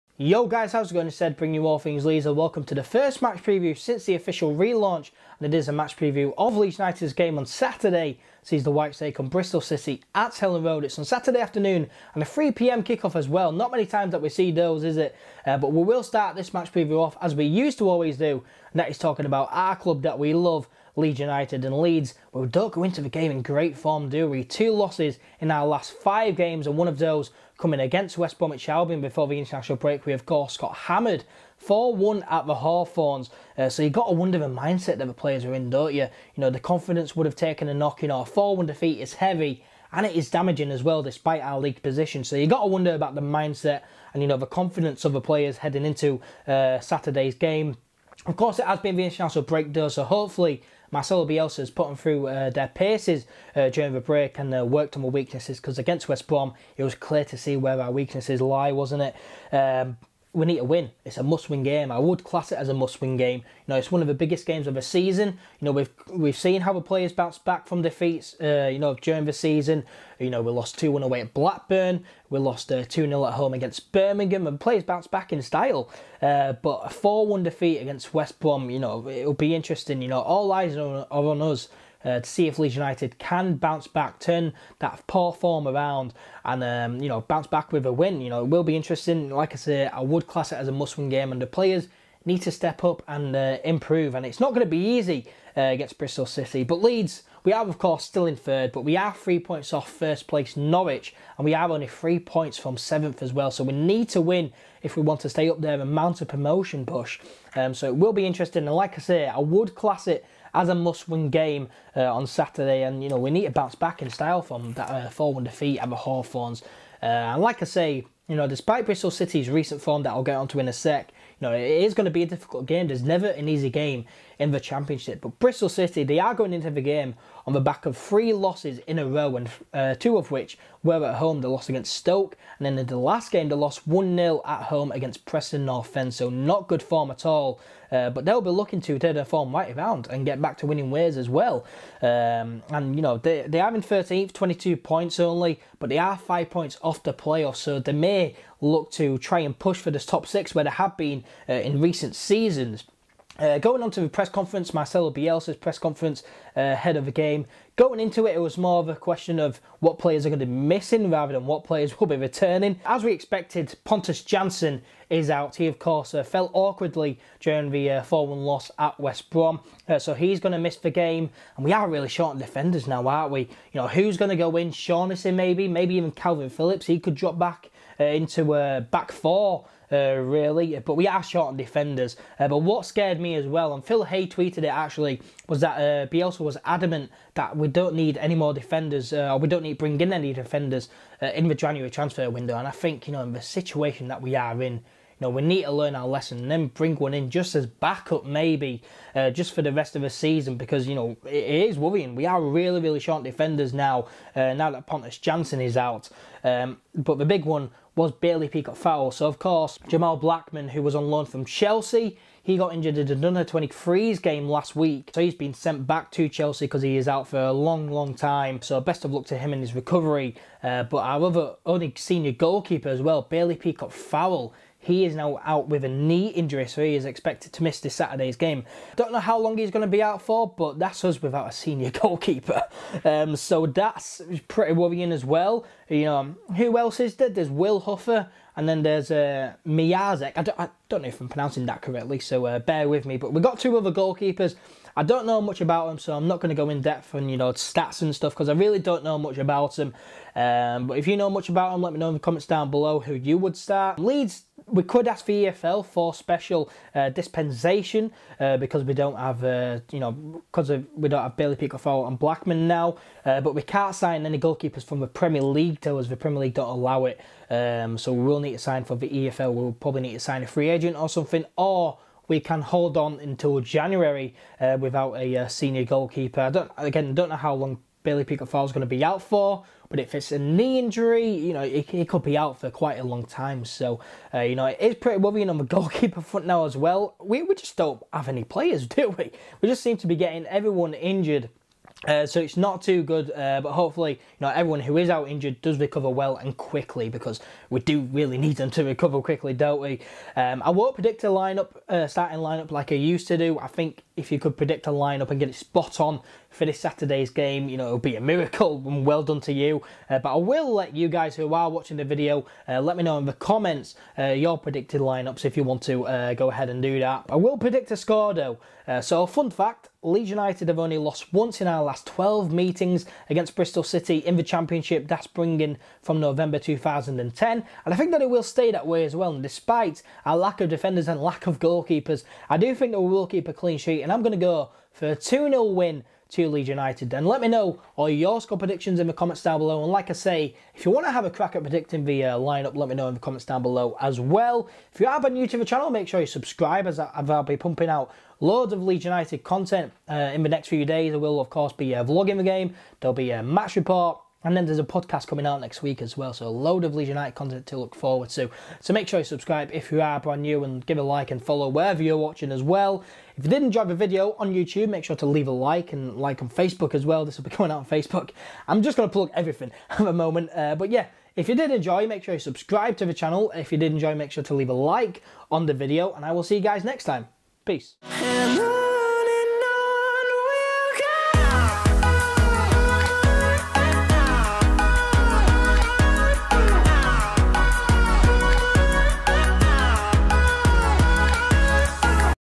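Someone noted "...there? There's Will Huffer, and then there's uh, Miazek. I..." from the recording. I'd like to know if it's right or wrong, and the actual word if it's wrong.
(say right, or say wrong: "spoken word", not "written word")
right.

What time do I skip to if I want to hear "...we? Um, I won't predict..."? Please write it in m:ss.
4:59.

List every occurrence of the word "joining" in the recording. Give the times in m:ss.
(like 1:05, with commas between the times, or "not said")
not said.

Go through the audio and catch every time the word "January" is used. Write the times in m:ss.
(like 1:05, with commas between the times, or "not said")
3:11, 4:33.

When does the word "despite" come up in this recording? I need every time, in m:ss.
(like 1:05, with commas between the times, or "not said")
0:41, 1:58, 5:29.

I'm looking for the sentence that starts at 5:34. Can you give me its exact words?
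And I'm going to go for a 2 0 win to Leeds United then.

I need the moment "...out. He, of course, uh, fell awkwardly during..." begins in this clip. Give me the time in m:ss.
2:45.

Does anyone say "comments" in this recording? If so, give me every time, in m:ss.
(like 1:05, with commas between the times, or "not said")
4:12, 5:13, 5:39, 5:43.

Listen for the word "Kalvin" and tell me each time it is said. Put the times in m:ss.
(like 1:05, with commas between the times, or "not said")
2:56.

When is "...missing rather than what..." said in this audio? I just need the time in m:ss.
2:40.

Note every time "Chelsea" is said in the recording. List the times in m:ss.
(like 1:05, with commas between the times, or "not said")
3:31, 3:36.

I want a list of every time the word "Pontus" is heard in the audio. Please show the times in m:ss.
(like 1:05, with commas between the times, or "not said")
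2:43, 3:24.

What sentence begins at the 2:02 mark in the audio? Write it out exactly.
There's never an easy game in the Championship.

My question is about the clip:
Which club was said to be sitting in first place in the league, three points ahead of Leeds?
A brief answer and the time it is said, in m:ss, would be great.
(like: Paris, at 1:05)
Norwich, at 1:40.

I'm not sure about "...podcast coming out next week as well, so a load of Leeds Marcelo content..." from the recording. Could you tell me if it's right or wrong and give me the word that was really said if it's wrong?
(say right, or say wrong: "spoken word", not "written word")
wrong: "United", not "Marcelo".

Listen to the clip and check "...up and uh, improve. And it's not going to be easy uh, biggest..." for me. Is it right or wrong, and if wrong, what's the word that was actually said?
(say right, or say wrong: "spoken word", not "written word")
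wrong: "against", not "biggest".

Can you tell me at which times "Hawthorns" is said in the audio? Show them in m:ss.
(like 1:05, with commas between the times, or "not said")
0:32, 1:55.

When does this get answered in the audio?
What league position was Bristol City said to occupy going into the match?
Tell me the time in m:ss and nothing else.
2:23.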